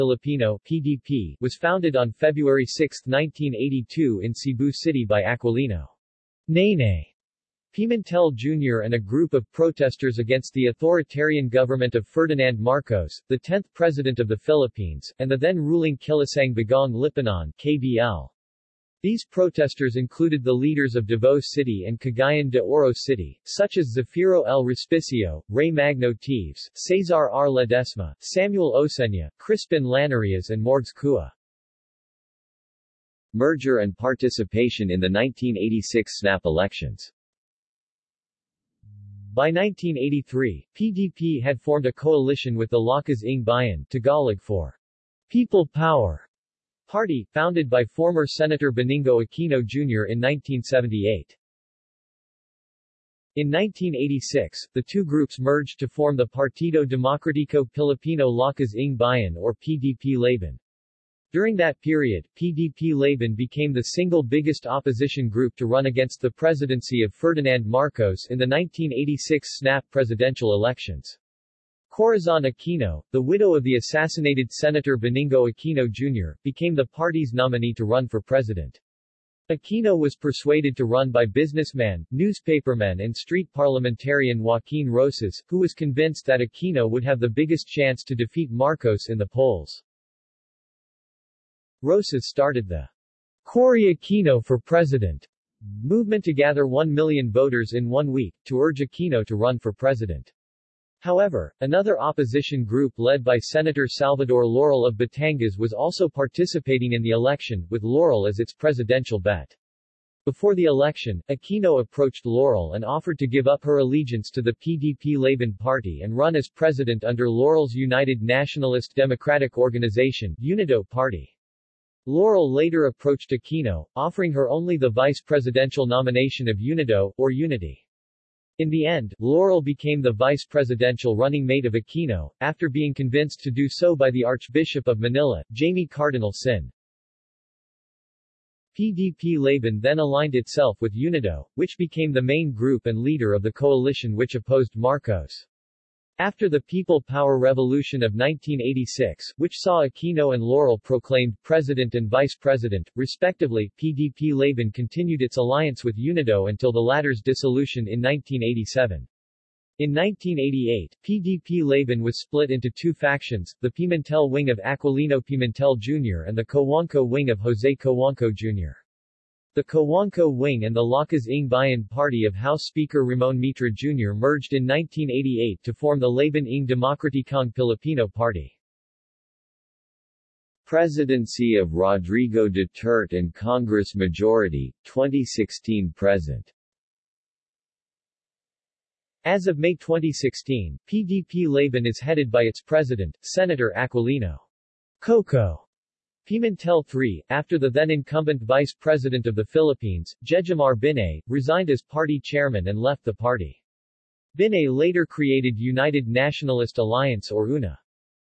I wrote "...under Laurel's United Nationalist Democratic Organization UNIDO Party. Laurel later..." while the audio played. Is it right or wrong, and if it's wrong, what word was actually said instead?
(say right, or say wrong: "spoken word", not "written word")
right.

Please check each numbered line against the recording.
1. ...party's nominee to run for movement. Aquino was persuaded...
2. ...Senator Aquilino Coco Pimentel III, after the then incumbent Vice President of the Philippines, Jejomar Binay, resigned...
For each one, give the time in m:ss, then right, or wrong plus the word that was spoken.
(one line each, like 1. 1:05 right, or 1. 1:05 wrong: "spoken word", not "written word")
1. 1:16 wrong: "president", not "movement"
2. 3:13 right.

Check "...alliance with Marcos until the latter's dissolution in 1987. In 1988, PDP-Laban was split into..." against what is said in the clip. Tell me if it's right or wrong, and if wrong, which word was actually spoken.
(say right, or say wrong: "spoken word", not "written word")
wrong: "UNIDO", not "Marcos".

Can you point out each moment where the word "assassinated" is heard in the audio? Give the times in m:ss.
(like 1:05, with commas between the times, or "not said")
1:13.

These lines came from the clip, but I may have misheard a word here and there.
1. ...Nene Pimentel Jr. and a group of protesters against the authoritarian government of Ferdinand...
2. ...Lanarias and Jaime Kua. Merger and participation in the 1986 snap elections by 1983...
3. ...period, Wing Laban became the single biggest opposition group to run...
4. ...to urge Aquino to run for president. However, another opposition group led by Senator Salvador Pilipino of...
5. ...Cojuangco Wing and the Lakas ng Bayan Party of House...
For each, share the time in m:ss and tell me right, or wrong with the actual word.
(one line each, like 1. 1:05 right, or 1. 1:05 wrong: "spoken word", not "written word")
1. 0:06 right
2. 0:29 wrong: "Morgs", not "Jaime"
3. 1:01 wrong: "PDP", not "Wing"
4. 1:38 wrong: "Laurel", not "Pilipino"
5. 2:49 right.